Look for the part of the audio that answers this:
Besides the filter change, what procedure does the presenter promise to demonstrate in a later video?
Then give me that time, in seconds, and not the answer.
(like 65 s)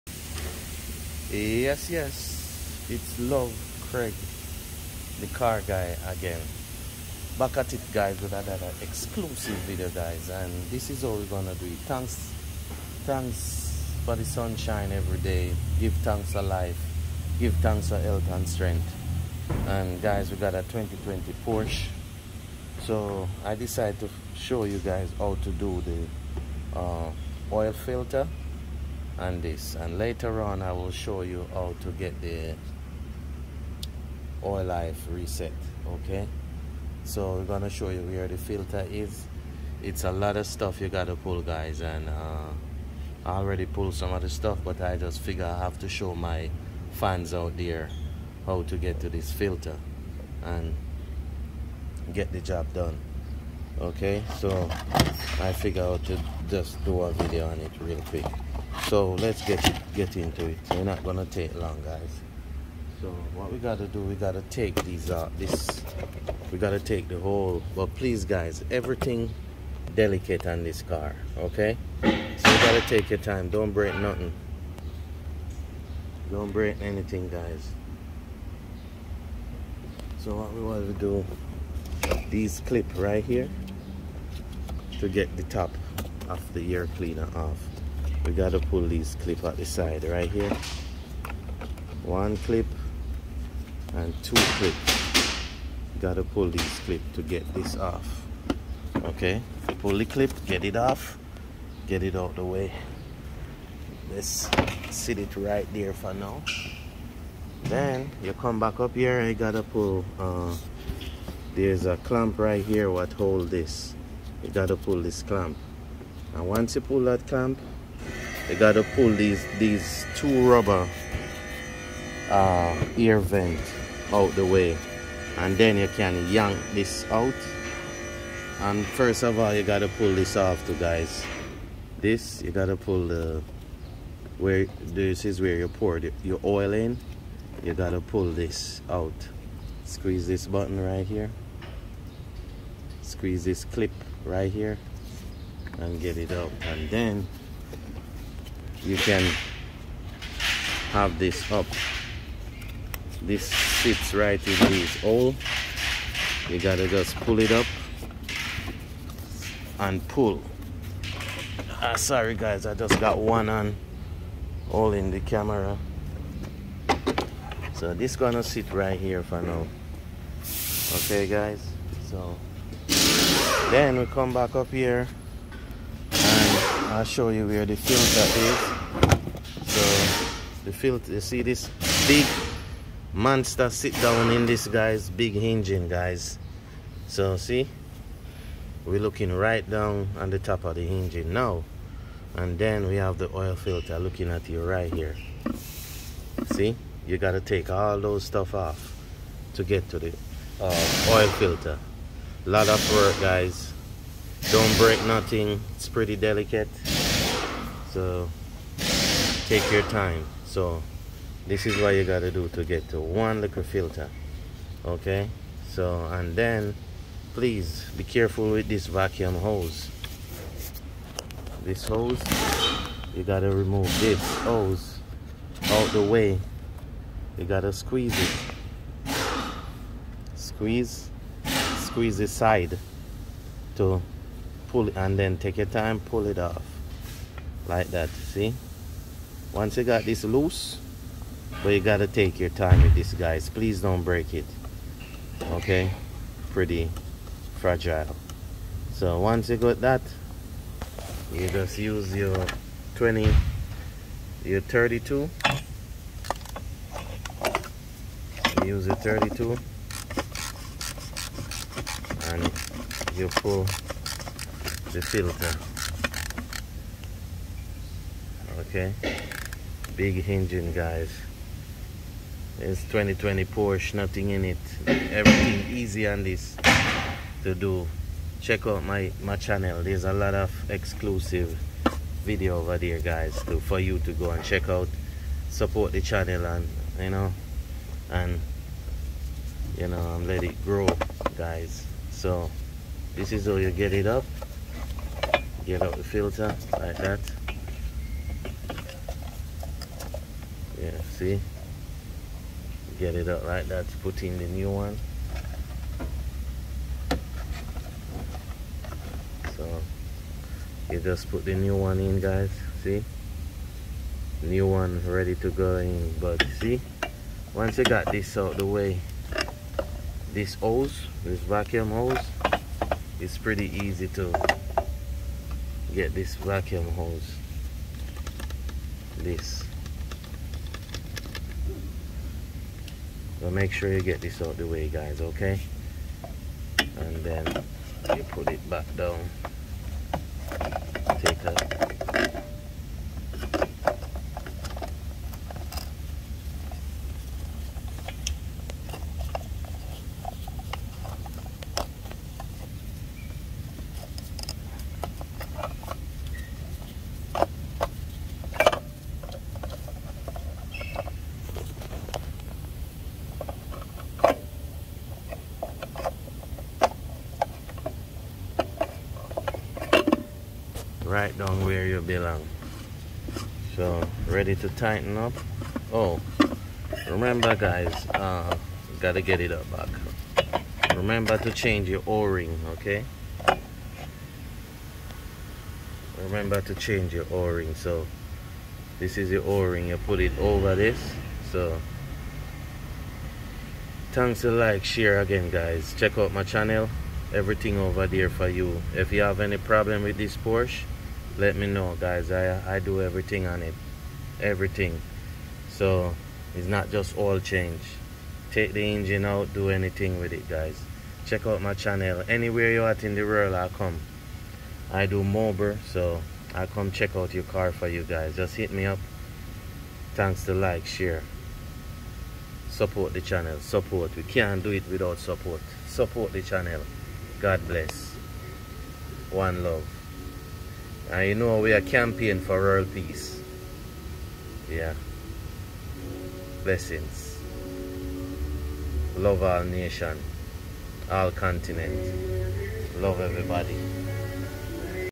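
34 s.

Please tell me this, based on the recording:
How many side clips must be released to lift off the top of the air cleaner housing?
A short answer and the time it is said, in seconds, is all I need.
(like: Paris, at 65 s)
2, at 92 s.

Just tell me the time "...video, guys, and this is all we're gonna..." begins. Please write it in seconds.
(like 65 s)
9 s.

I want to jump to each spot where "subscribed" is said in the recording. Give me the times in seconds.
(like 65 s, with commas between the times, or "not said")
not said.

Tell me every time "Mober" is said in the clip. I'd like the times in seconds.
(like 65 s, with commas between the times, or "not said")
415 s.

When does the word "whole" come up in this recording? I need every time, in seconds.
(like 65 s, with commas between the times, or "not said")
67 s.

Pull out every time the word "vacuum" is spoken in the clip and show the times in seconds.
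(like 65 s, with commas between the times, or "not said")
218 s, 321 s, 326 s.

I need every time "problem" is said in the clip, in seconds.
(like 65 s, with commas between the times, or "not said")
399 s.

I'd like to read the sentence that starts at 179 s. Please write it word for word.
So the filter, you see this big monster sit down in this guy's big engine, guys.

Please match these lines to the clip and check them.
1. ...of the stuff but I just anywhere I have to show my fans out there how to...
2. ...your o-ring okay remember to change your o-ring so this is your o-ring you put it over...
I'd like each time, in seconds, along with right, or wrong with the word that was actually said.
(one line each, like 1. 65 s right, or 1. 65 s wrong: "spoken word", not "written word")
1. 44 s wrong: "figure", not "anywhere"
2. 381 s right.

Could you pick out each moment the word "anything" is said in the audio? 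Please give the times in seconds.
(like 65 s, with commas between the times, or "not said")
76 s, 409 s.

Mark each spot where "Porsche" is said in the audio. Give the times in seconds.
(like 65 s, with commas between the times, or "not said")
21 s, 273 s, 400 s.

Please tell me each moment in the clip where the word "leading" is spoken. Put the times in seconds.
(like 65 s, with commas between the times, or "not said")
not said.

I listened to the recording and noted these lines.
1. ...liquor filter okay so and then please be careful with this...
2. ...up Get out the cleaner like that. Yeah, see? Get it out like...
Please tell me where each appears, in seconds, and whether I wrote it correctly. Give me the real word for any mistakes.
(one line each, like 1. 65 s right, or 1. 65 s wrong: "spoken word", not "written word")
1. 213 s right
2. 294 s wrong: "filter", not "cleaner".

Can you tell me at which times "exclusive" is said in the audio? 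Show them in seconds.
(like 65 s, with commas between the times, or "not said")
8 s, 280 s.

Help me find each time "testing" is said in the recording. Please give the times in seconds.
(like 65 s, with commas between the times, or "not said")
not said.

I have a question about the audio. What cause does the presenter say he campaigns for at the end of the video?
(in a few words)
World peace.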